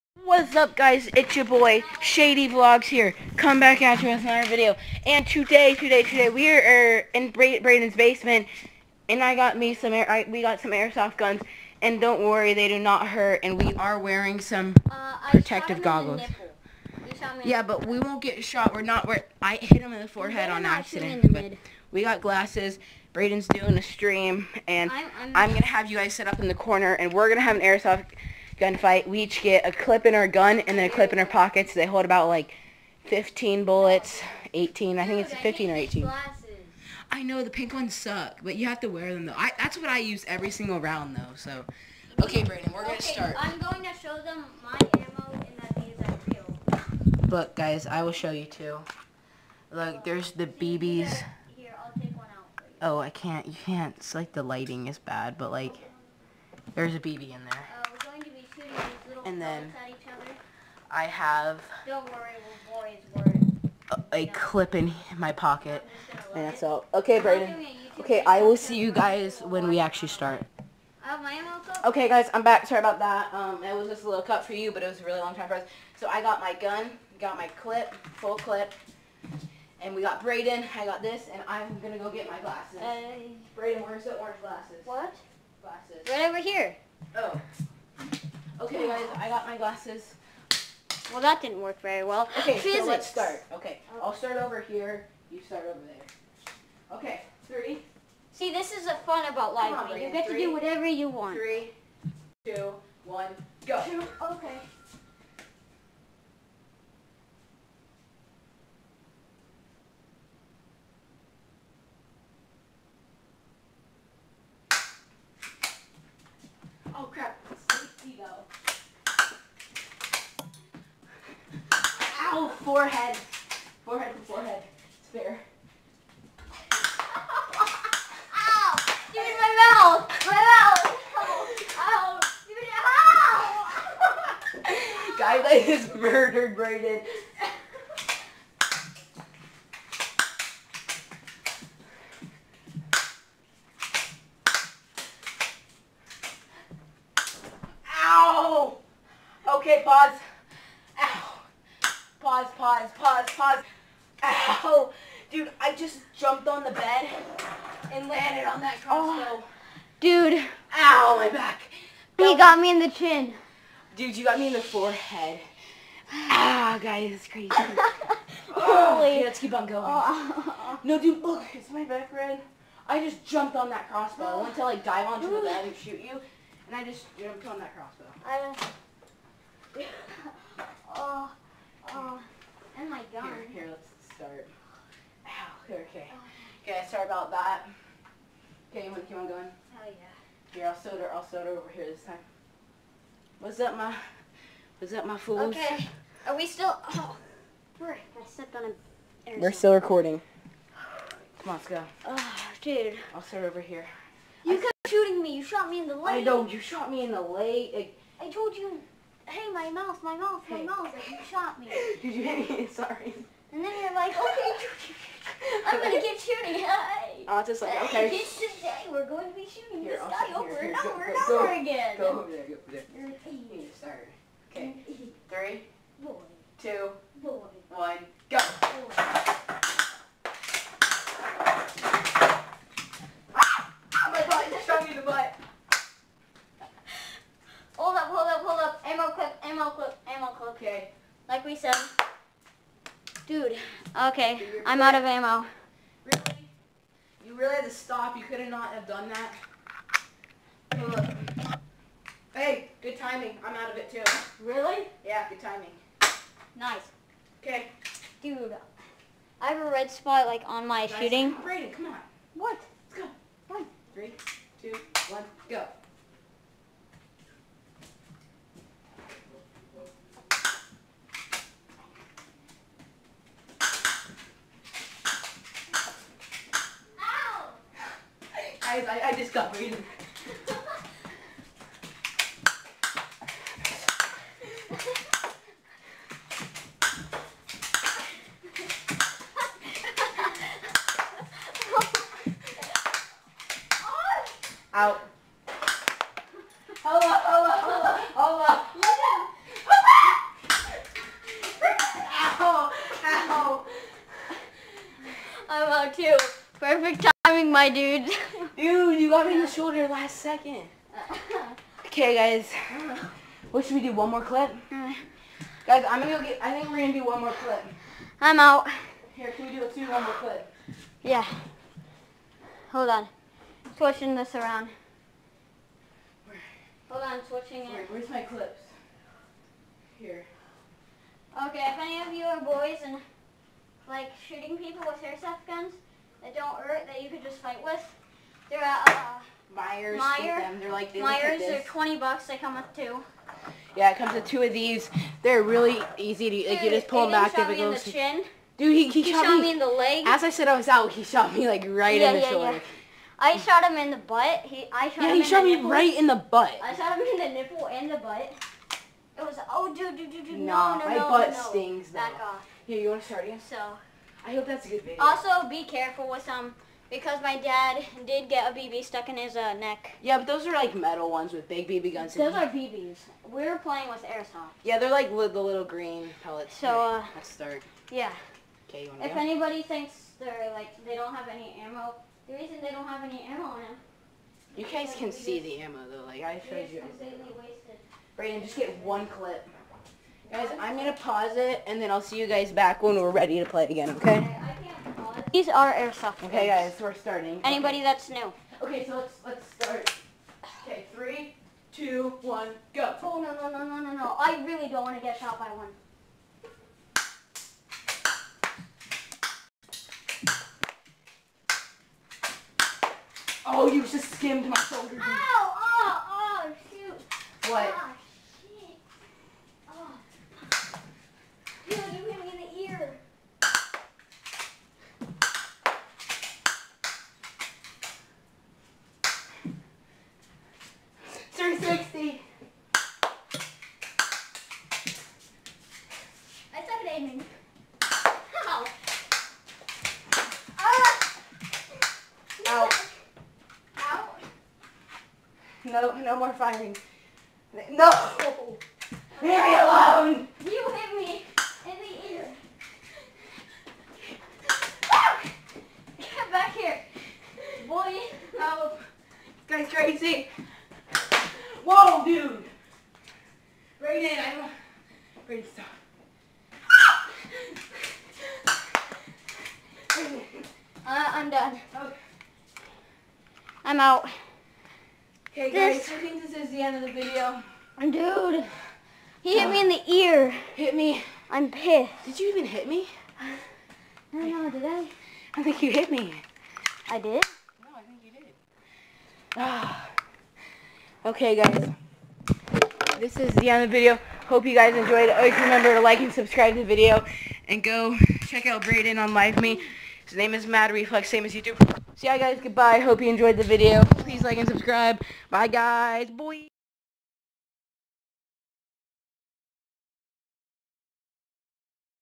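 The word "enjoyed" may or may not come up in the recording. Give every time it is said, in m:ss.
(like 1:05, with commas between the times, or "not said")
8:14, 8:23.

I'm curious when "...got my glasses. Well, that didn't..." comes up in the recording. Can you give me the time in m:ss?
1:29.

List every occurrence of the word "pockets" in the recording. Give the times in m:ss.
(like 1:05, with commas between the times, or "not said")
0:31, 1:05.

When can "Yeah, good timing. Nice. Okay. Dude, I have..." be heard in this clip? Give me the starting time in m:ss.
4:15.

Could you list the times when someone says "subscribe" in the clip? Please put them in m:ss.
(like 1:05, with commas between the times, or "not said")
8:16, 8:24.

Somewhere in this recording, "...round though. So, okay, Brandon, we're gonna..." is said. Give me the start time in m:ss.
0:40.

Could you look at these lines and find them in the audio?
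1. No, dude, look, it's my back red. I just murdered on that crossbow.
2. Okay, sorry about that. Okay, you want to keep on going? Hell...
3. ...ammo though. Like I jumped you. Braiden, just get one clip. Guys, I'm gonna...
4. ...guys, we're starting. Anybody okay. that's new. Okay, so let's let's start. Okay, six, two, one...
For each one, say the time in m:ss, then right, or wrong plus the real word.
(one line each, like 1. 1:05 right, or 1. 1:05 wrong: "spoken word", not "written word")
1. 2:50 wrong: "jumped", not "murdered"
2. 3:06 right
3. 6:25 wrong: "showed", not "jumped"
4. 6:36 wrong: "three", not "six".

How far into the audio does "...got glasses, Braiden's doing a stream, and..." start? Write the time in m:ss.
0:22.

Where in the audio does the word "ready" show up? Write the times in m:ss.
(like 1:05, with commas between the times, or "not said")
6:33, 7:45.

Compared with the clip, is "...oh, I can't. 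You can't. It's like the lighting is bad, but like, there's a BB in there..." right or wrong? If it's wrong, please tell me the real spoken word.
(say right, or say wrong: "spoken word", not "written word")
right.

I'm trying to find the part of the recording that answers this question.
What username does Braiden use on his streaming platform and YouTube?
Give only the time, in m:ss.
8:20.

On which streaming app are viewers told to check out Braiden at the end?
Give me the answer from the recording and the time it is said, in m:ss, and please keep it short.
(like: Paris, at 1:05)
LiveMe, at 8:19.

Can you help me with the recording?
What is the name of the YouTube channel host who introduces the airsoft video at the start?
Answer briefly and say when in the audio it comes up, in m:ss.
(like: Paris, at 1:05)
Shady Vlogz, at 0:01.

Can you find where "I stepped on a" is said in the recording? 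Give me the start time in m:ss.
3:17.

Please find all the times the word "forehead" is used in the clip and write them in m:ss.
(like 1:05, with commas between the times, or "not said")
0:20, 2:44.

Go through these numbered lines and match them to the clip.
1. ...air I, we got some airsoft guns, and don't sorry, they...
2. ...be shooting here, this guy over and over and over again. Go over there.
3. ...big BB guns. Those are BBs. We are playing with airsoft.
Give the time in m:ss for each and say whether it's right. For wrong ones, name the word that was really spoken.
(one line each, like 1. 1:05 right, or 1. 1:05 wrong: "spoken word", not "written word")
1. 0:09 wrong: "worry", not "sorry"
2. 3:39 right
3. 6:11 right.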